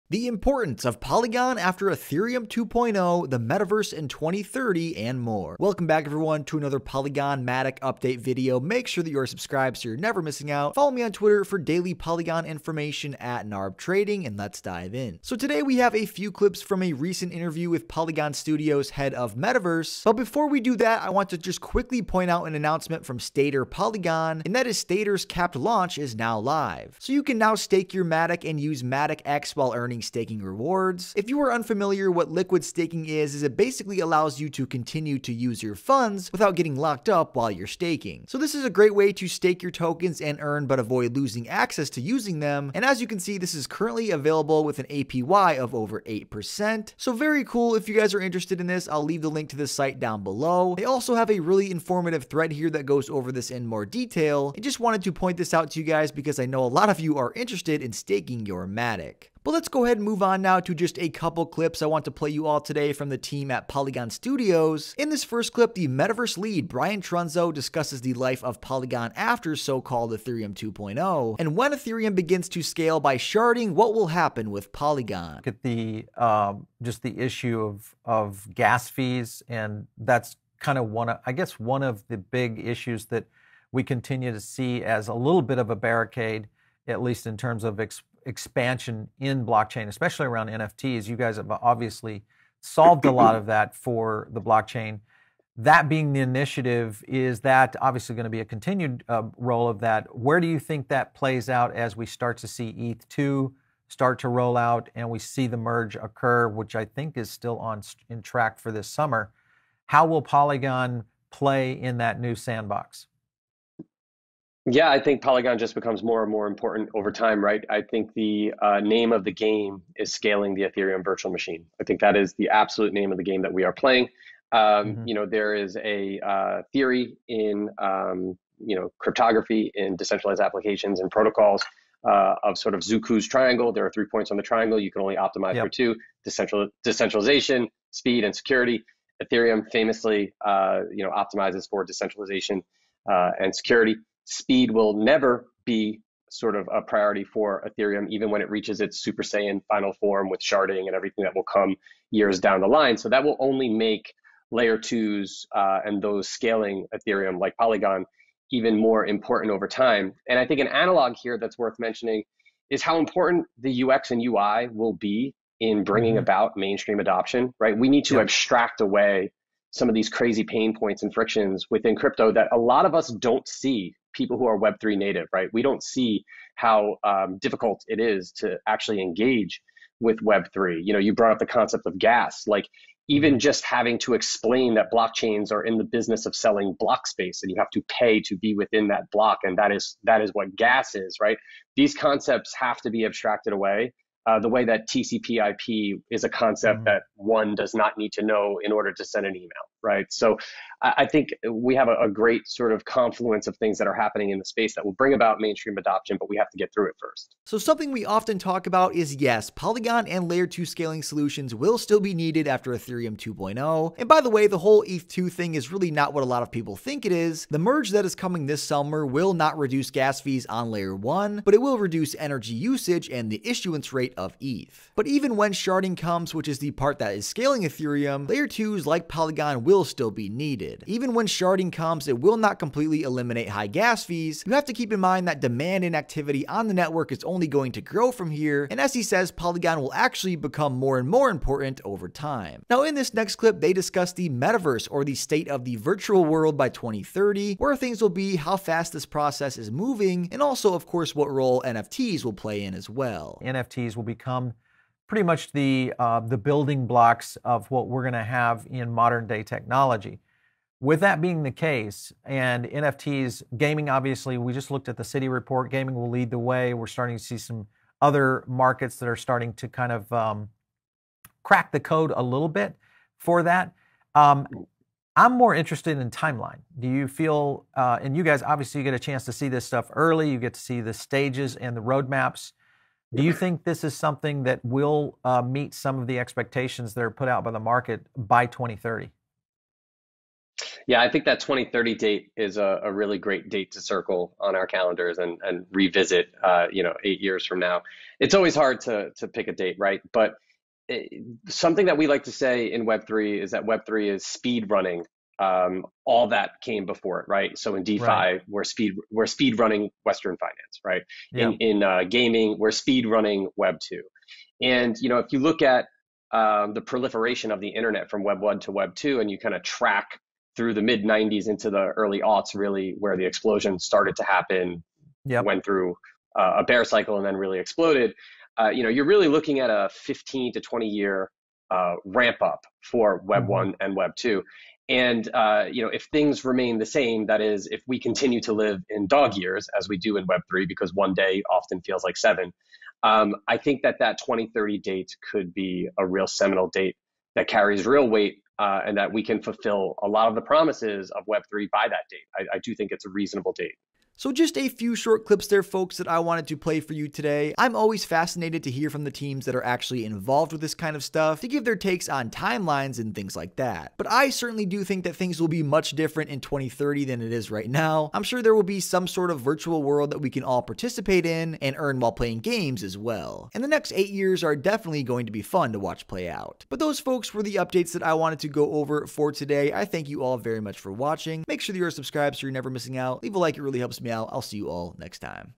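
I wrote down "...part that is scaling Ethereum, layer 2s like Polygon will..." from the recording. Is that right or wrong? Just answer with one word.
right.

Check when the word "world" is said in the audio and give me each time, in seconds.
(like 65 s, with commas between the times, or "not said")
246 s, 369 s.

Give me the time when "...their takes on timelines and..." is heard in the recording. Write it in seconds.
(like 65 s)
361 s.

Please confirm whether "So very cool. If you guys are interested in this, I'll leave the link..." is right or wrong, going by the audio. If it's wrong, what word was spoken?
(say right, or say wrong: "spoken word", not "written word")
right.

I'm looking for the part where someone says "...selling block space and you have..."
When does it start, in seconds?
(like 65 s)
186 s.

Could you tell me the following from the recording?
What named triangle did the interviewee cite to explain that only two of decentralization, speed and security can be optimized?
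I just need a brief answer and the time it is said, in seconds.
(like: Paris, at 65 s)
Zooko's triangle, at 132 s.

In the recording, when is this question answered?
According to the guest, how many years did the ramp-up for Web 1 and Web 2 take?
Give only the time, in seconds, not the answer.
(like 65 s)
329 s.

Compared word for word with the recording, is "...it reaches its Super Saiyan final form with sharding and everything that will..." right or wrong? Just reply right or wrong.
right.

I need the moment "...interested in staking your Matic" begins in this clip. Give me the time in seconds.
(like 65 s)
57 s.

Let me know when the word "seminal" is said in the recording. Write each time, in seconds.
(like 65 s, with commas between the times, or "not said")
346 s.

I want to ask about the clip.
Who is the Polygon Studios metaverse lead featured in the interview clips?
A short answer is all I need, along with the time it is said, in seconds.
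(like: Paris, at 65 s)
Brian Trunzo, at 66 s.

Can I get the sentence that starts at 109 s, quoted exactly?
How will Polygon play in that new sandbox?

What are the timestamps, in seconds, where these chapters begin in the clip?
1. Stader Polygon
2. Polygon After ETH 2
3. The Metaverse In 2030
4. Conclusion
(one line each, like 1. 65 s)
1. 15 s
2. 59 s
3. 242 s
4. 354 s.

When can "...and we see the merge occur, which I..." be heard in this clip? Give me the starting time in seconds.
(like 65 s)
104 s.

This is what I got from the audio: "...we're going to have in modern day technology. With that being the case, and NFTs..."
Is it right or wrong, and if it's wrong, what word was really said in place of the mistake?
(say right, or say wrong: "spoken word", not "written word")
right.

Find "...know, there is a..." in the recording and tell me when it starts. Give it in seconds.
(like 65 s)
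125 s.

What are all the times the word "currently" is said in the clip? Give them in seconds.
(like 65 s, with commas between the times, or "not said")
43 s.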